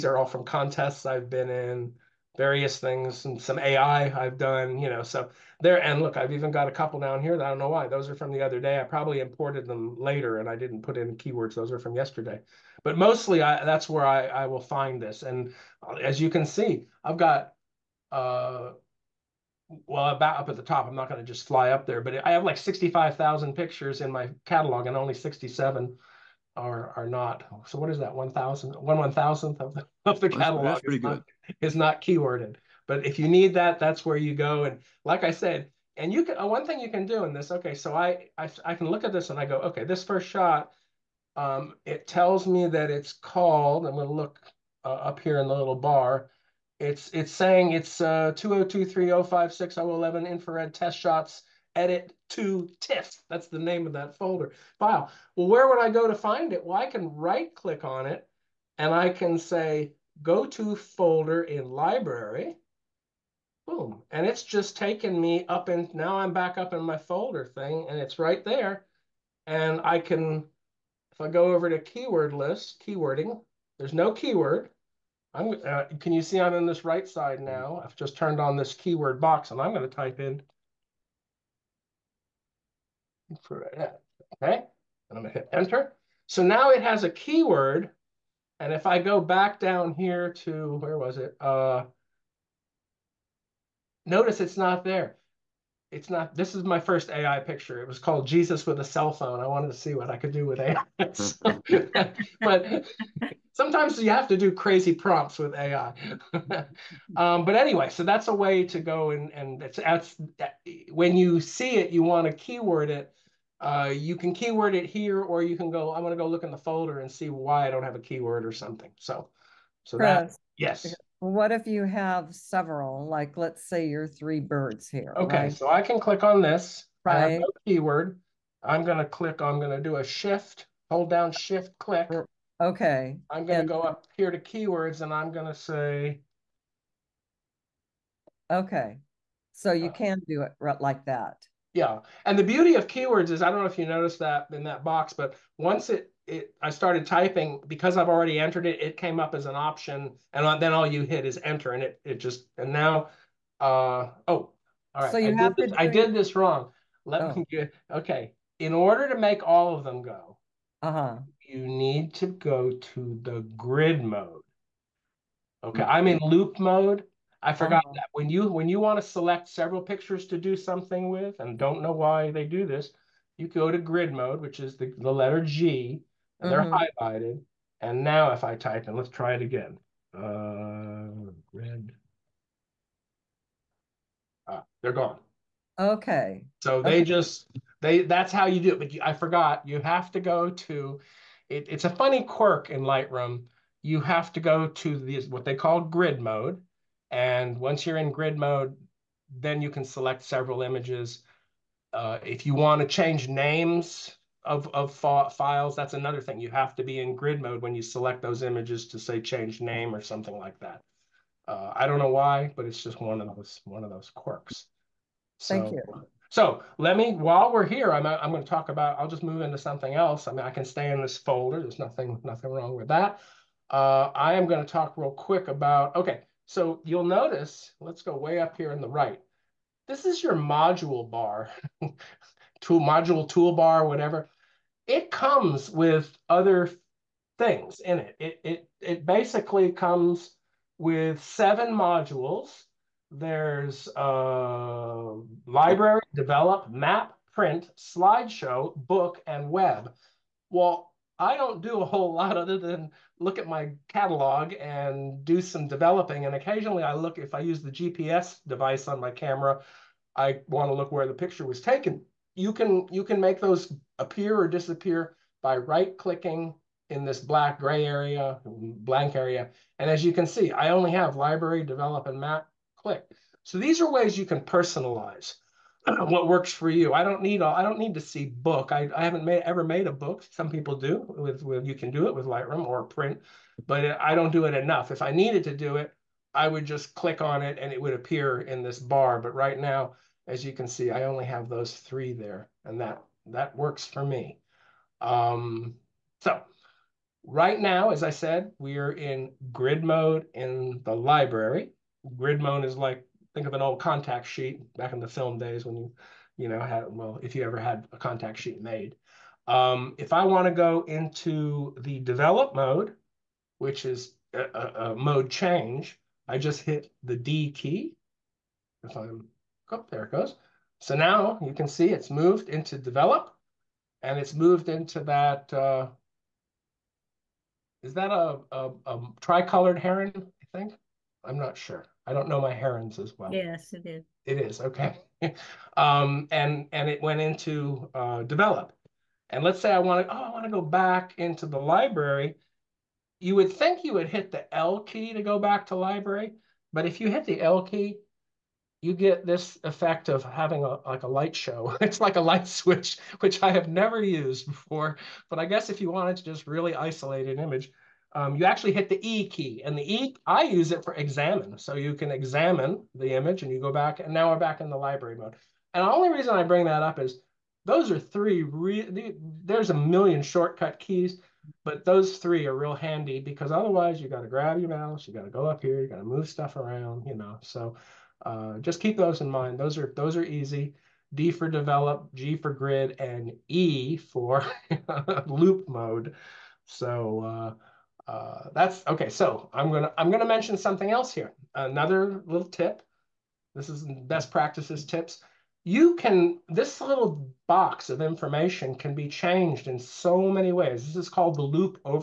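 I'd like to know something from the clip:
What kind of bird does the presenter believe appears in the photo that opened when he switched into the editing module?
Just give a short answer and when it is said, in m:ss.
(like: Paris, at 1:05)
tricolored heron, at 5:29.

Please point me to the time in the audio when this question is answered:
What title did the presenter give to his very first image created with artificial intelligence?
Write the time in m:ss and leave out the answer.
1:38.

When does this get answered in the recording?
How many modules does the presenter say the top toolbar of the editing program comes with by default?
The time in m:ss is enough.
4:01.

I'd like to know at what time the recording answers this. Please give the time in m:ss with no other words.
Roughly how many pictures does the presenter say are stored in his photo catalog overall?
0:22.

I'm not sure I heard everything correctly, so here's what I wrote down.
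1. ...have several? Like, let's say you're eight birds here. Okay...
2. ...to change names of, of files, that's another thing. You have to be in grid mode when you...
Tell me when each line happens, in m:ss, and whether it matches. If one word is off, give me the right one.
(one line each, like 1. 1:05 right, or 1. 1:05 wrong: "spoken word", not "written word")
1. 2:01 wrong: "three", not "eight"
2. 3:22 right.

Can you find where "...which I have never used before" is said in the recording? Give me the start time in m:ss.
5:53.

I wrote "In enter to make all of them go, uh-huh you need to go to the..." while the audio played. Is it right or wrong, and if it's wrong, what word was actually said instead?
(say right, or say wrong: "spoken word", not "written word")
wrong: "order", not "enter".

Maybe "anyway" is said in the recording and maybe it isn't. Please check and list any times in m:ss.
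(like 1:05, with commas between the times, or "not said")
1:47.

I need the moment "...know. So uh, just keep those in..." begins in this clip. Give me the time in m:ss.
6:17.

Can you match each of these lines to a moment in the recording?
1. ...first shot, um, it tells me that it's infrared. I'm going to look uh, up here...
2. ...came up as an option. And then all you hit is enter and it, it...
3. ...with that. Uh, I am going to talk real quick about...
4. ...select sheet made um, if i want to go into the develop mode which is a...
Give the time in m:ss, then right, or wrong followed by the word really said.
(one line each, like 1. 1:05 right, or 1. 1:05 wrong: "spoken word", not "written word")
1. 0:40 wrong: "called", not "infrared"
2. 2:28 right
3. 3:42 right
4. 5:07 wrong: "contact", not "select".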